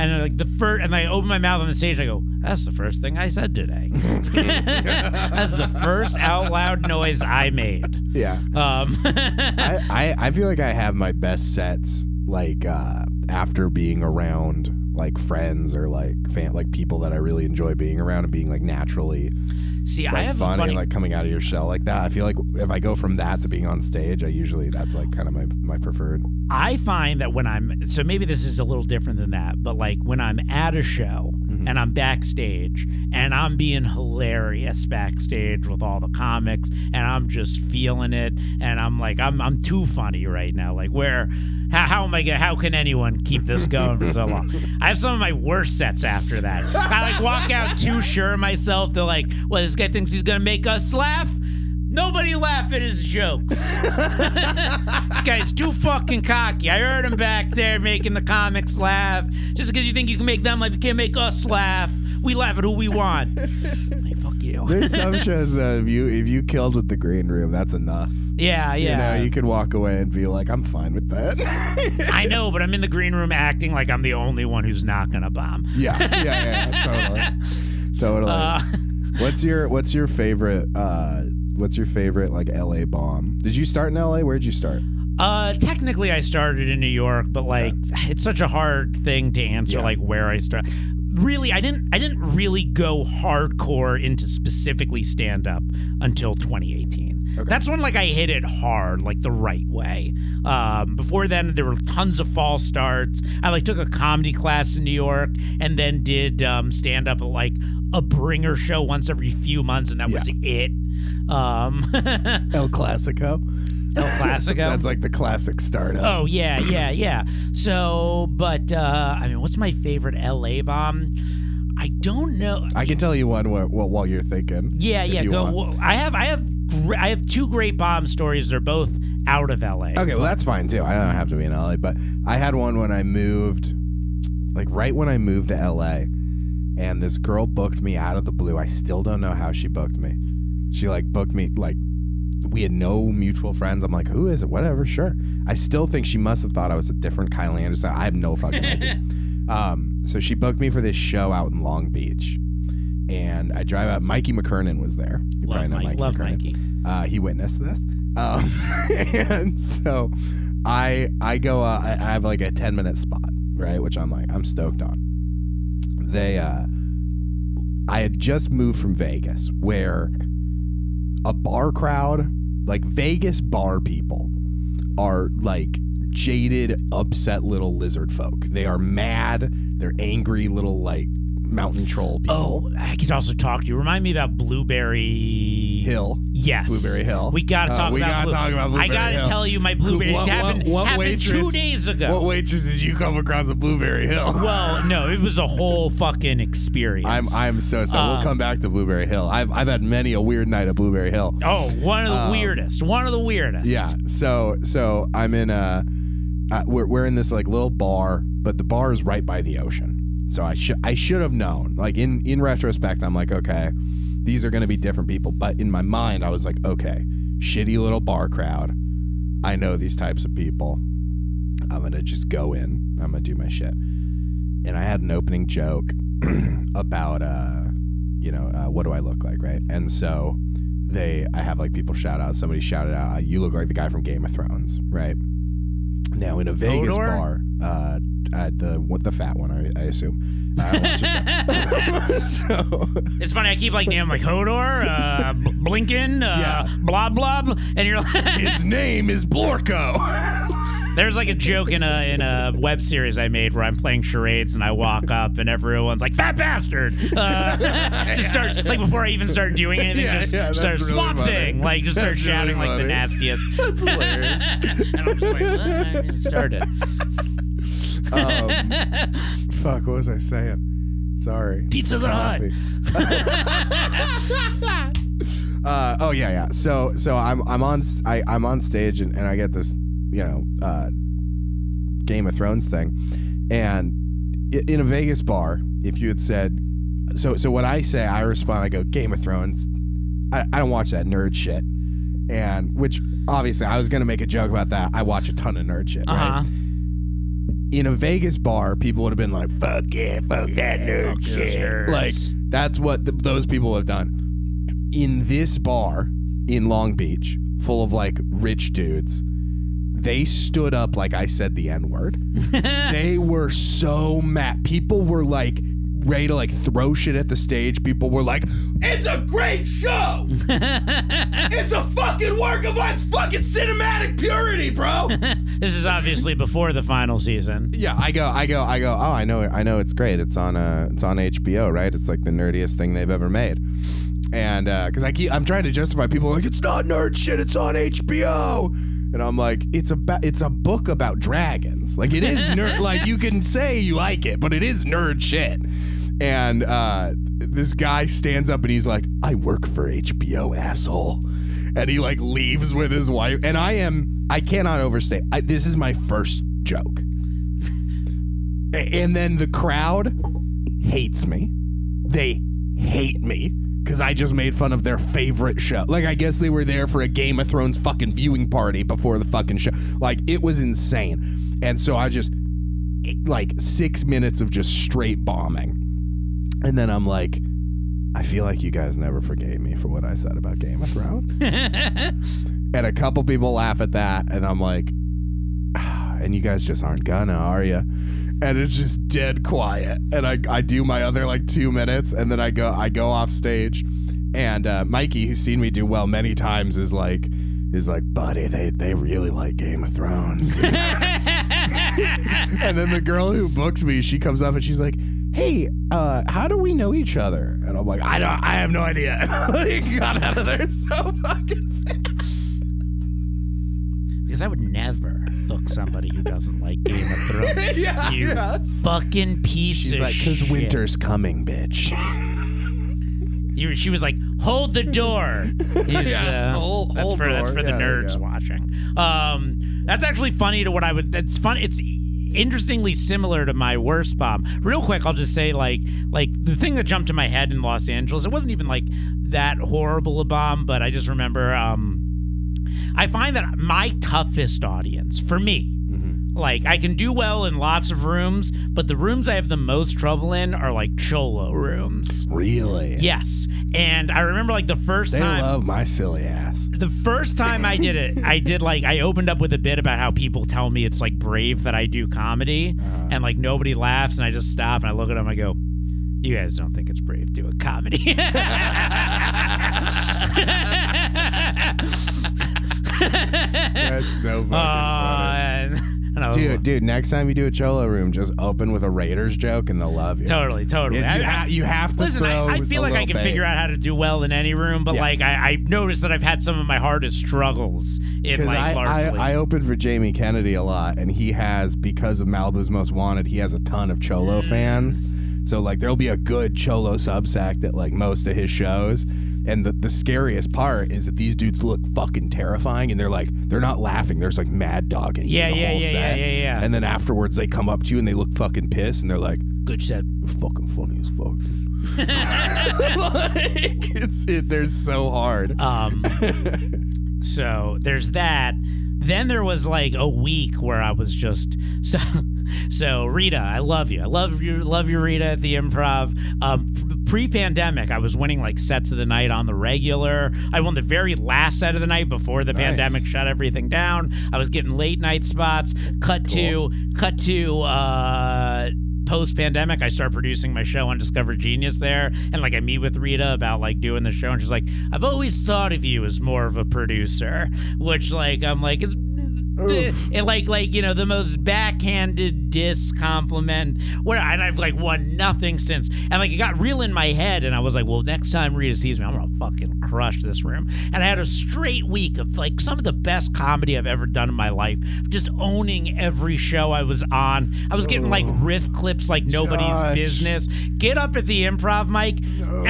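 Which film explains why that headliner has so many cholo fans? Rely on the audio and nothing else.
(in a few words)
Malibu's Most Wanted.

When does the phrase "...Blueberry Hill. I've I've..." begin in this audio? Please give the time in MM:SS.
03:18.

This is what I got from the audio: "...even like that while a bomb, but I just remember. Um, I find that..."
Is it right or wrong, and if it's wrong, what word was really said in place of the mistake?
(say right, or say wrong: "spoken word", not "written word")
wrong: "horrible", not "while".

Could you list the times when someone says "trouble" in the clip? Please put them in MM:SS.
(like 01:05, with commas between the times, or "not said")
07:29.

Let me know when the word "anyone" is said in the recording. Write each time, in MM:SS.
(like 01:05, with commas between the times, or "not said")
00:42.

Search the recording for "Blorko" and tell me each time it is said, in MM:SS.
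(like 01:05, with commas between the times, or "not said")
04:09.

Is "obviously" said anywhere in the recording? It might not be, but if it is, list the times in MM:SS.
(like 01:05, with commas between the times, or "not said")
04:53, 05:25.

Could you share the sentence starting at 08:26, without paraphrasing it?
And then afterwards they come up to you and they look fucking pissed and they're like, Good shit.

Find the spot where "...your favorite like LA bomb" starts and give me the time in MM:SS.
01:21.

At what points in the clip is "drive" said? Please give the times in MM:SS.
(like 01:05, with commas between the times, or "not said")
02:33.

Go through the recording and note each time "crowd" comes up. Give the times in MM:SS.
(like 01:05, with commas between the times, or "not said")
02:51, 03:38, 05:59.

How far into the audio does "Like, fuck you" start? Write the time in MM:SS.
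01:03.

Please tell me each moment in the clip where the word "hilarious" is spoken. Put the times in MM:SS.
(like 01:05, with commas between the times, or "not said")
00:33, 04:23.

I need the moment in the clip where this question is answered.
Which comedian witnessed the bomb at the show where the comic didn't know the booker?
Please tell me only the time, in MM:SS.
02:34.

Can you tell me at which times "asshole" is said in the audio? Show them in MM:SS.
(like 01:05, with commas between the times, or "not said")
05:50.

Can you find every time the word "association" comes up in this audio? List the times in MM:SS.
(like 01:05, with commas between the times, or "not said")
not said.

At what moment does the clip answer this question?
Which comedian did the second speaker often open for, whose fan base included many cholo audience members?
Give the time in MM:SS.
08:09.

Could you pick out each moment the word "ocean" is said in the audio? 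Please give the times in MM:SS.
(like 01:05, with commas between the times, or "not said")
03:29.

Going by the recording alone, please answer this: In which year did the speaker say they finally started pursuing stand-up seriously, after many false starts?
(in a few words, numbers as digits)
2018.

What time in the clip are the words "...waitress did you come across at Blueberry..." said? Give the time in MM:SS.
03:12.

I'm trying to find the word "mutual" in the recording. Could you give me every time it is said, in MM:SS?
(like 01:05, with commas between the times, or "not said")
02:23.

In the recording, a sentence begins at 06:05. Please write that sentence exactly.
Like, I guess they were there for a Game of Thrones fucking viewing party before the fucking show.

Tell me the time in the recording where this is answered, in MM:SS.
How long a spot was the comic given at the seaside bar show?
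02:42.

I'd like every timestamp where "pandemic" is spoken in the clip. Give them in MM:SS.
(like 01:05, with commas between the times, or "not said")
08:47, 08:52, 08:59.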